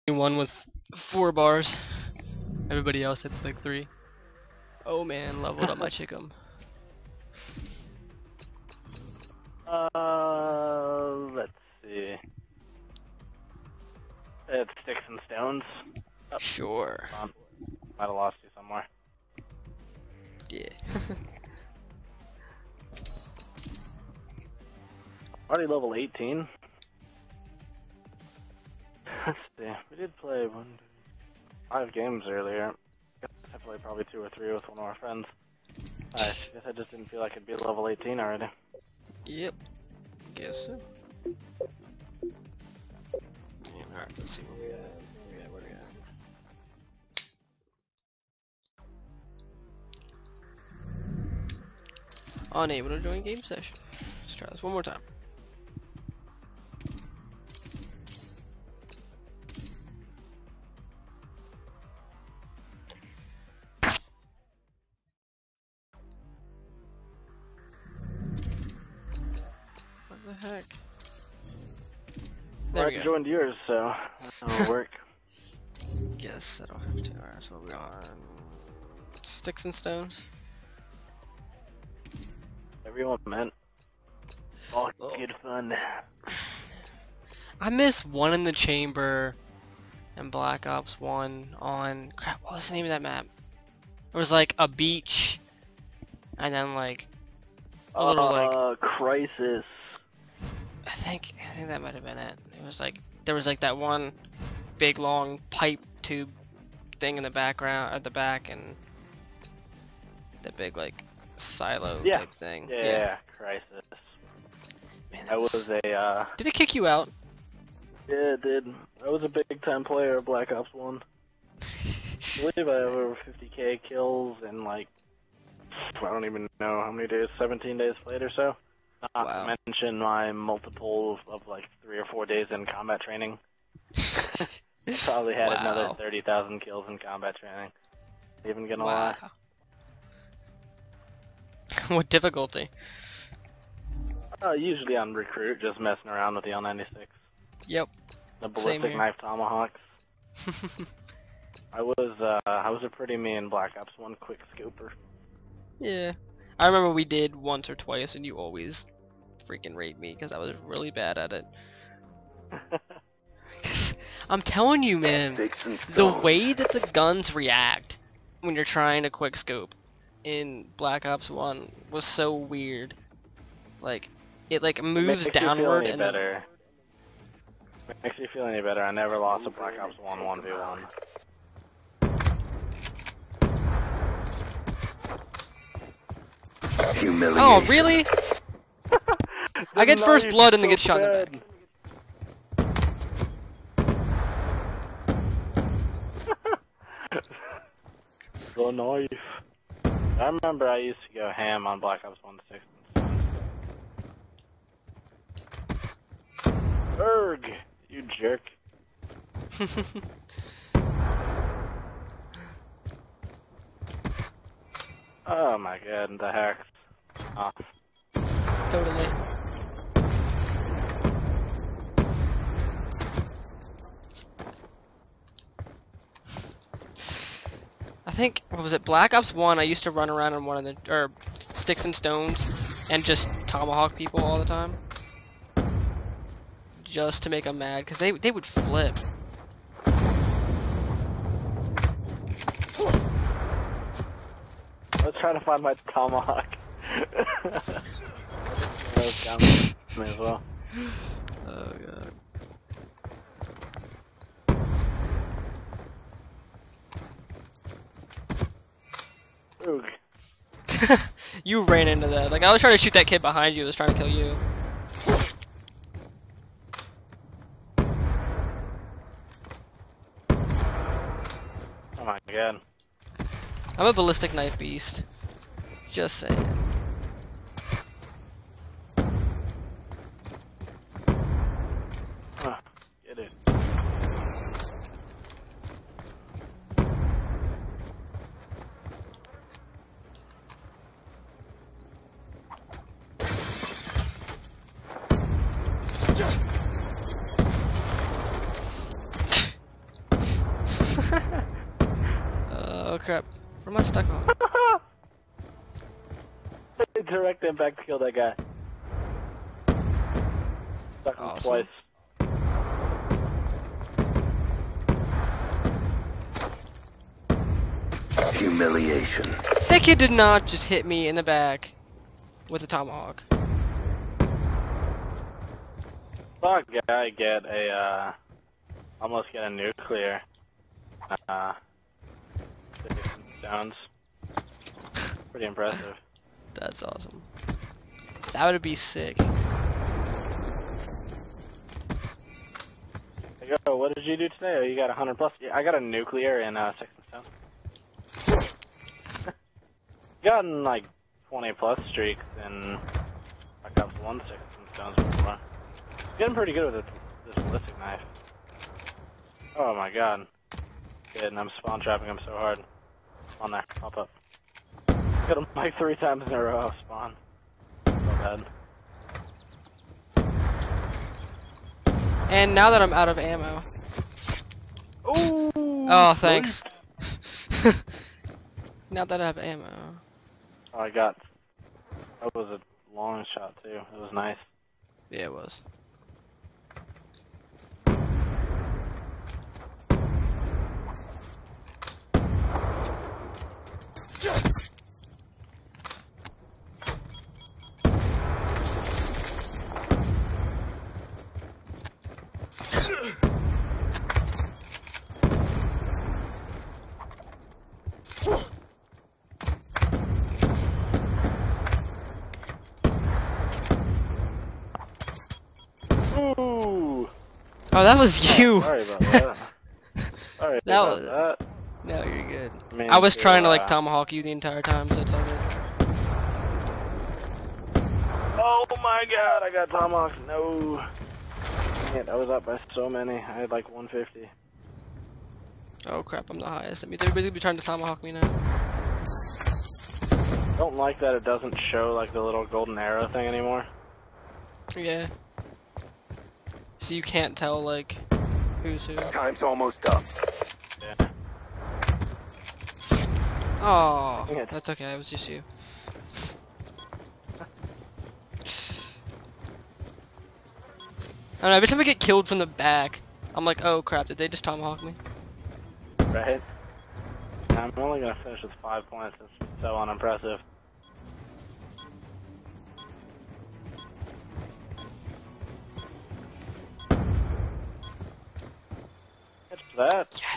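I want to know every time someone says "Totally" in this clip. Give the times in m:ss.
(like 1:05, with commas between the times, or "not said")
3:37.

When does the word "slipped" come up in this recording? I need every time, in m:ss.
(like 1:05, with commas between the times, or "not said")
not said.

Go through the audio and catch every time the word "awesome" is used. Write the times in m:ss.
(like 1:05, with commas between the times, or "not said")
5:11, 5:36.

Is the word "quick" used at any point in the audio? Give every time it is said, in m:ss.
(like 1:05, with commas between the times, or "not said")
2:34, 2:49.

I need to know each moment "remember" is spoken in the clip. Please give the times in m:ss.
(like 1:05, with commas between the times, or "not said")
2:36, 3:20.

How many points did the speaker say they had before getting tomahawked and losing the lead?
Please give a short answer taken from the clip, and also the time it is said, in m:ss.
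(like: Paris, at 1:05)
150, at 7:13.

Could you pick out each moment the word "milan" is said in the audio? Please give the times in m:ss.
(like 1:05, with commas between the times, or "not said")
not said.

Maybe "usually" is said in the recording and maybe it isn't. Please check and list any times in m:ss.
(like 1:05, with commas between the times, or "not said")
2:24.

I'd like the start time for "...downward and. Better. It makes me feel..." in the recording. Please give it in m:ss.
2:55.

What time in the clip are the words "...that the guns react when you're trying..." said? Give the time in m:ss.
2:46.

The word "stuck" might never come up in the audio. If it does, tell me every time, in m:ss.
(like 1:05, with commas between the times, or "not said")
5:03, 5:11.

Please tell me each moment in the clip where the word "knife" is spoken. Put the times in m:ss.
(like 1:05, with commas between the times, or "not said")
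2:28, 3:18, 4:34, 5:57.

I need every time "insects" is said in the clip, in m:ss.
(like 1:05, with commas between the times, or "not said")
not said.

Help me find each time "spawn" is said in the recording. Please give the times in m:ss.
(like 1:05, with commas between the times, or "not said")
6:01, 6:06.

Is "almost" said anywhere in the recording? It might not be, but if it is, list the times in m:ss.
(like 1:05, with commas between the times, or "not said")
5:29, 7:29.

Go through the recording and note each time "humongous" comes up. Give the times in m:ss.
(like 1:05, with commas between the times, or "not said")
not said.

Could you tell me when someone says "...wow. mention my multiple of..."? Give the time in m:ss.
2:09.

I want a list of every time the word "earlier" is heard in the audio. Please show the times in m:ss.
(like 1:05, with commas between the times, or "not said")
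0:32.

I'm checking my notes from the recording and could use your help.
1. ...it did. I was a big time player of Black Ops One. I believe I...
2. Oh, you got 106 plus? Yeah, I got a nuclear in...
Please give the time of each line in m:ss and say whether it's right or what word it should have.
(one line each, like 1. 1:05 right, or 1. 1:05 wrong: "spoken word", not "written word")
1. 1:58 right
2. 5:44 wrong: "100", not "106".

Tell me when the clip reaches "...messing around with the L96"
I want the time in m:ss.
2:25.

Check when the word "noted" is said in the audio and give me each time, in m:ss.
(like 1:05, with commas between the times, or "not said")
not said.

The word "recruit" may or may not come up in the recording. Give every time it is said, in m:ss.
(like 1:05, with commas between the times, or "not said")
2:25.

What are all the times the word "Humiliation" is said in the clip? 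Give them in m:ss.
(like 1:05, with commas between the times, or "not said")
3:06, 5:18.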